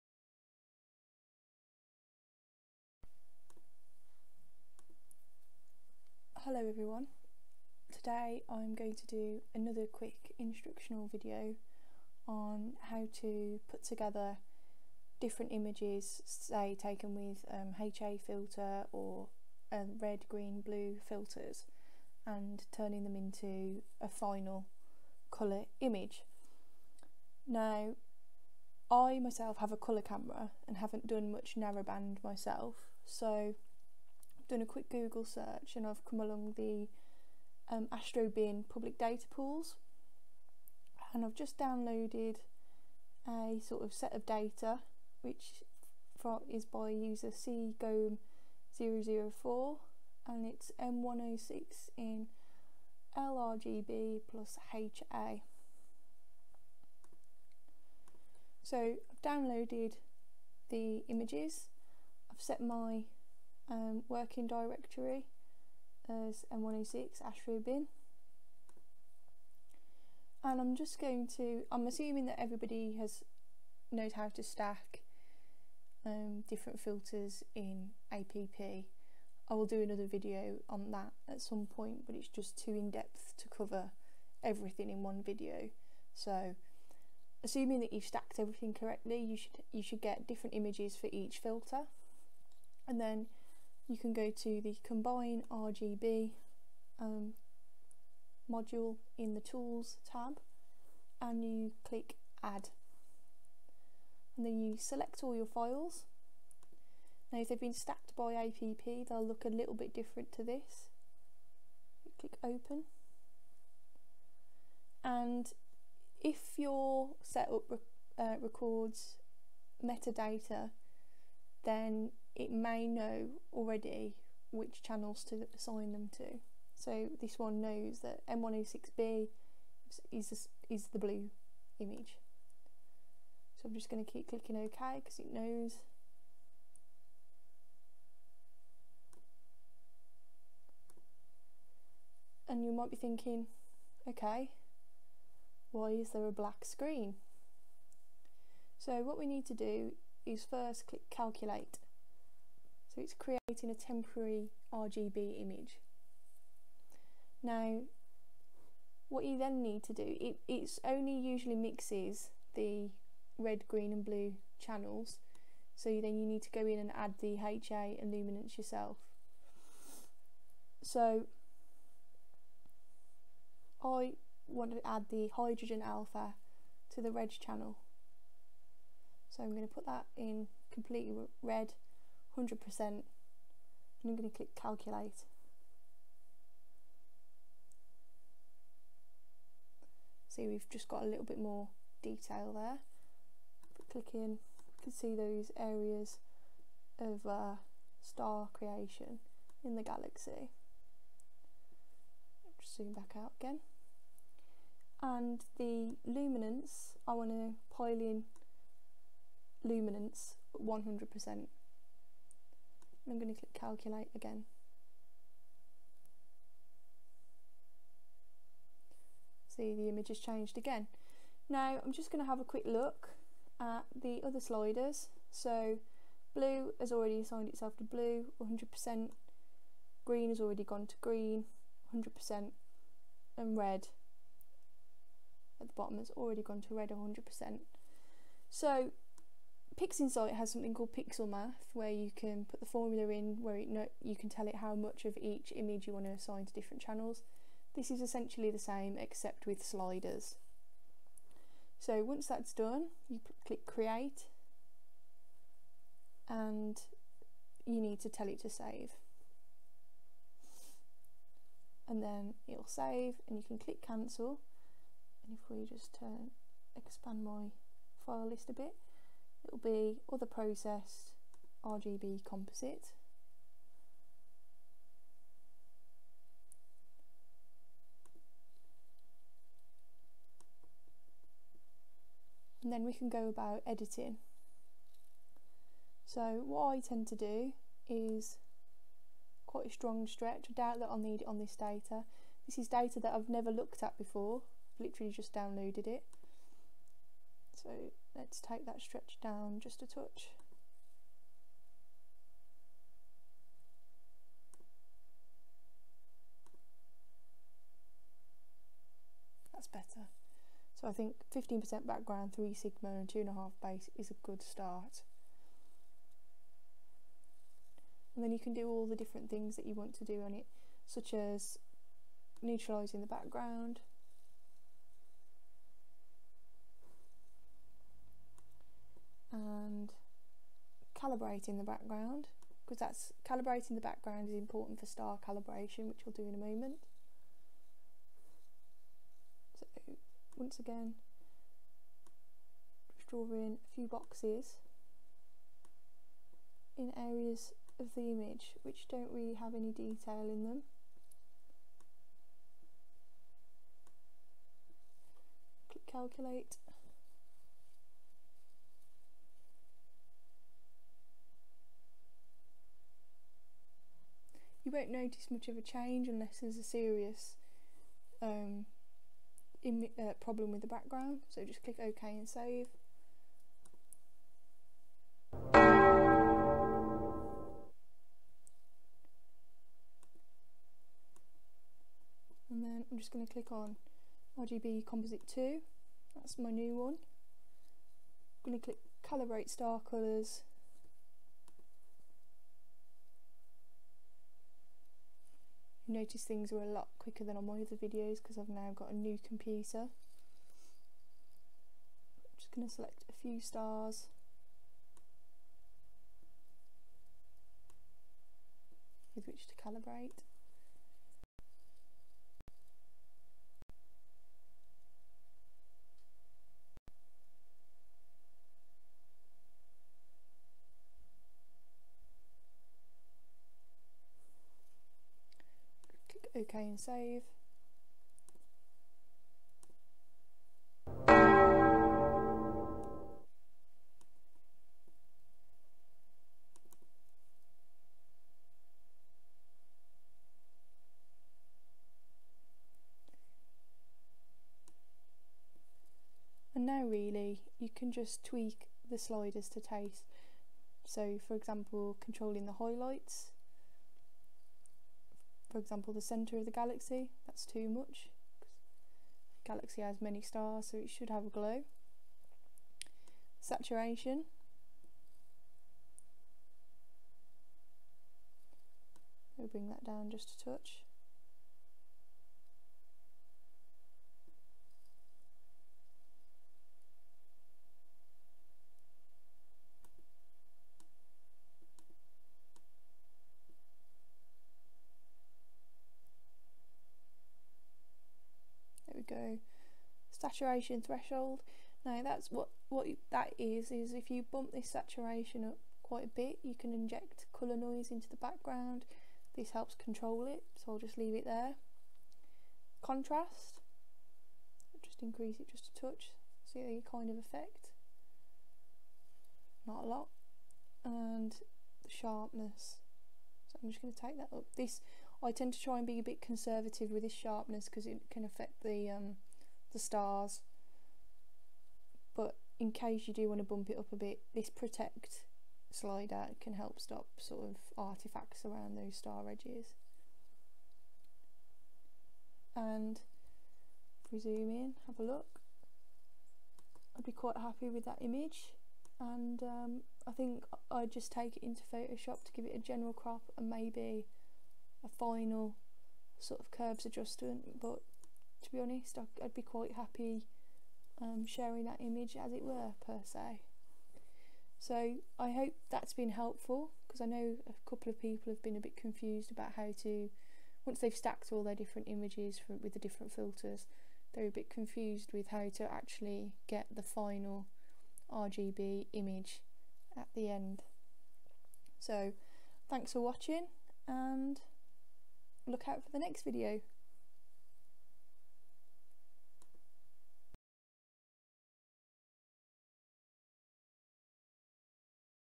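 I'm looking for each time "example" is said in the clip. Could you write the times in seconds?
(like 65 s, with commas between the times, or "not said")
451 s, 455 s.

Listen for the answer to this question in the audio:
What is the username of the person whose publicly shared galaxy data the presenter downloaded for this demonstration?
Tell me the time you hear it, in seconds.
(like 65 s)
47 s.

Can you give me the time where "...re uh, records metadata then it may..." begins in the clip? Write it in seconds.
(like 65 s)
117 s.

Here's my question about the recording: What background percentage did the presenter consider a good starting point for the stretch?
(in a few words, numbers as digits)
15%.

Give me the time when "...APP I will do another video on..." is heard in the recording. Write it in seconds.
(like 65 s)
78 s.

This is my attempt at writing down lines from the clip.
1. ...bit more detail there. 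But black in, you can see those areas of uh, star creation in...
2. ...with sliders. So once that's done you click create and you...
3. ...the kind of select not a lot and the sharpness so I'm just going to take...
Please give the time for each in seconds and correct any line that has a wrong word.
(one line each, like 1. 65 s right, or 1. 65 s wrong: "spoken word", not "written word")
1. 191 s wrong: "click", not "black"
2. 249 s right
3. 506 s wrong: "effect", not "select".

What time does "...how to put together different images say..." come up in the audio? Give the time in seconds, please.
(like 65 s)
12 s.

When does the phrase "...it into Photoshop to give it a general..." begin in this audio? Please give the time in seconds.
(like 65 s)
541 s.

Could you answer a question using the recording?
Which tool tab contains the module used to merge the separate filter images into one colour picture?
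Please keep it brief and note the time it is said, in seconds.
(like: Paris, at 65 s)
tools tab, at 99 s.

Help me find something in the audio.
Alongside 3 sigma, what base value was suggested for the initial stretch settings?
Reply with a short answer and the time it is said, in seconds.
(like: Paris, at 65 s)
2.5, at 313 s.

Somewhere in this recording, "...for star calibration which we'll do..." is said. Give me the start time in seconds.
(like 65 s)
334 s.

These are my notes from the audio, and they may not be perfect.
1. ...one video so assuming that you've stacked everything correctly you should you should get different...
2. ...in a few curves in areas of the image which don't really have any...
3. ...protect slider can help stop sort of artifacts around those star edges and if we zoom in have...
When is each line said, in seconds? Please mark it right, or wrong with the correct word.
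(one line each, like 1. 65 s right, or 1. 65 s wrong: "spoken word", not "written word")
1. 85 s right
2. 343 s wrong: "boxes", not "curves"
3. 524 s right.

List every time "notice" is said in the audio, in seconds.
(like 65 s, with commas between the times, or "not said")
364 s, 395 s.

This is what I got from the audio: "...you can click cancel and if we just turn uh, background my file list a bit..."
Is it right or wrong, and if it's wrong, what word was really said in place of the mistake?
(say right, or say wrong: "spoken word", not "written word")
wrong: "expand", not "background".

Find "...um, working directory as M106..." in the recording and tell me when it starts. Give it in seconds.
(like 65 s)
63 s.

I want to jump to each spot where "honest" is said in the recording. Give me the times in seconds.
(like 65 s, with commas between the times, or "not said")
548 s.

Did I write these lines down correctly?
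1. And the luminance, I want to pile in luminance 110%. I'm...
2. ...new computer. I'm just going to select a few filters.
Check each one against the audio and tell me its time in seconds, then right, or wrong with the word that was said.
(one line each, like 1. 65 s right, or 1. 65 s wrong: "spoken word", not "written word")
1. 205 s wrong: "100", not "110"
2. 398 s wrong: "stars", not "filters".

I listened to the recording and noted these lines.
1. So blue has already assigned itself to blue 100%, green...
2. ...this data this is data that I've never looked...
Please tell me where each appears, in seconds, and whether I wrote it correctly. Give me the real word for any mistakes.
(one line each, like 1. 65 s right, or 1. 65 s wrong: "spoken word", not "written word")
1. 225 s right
2. 291 s right.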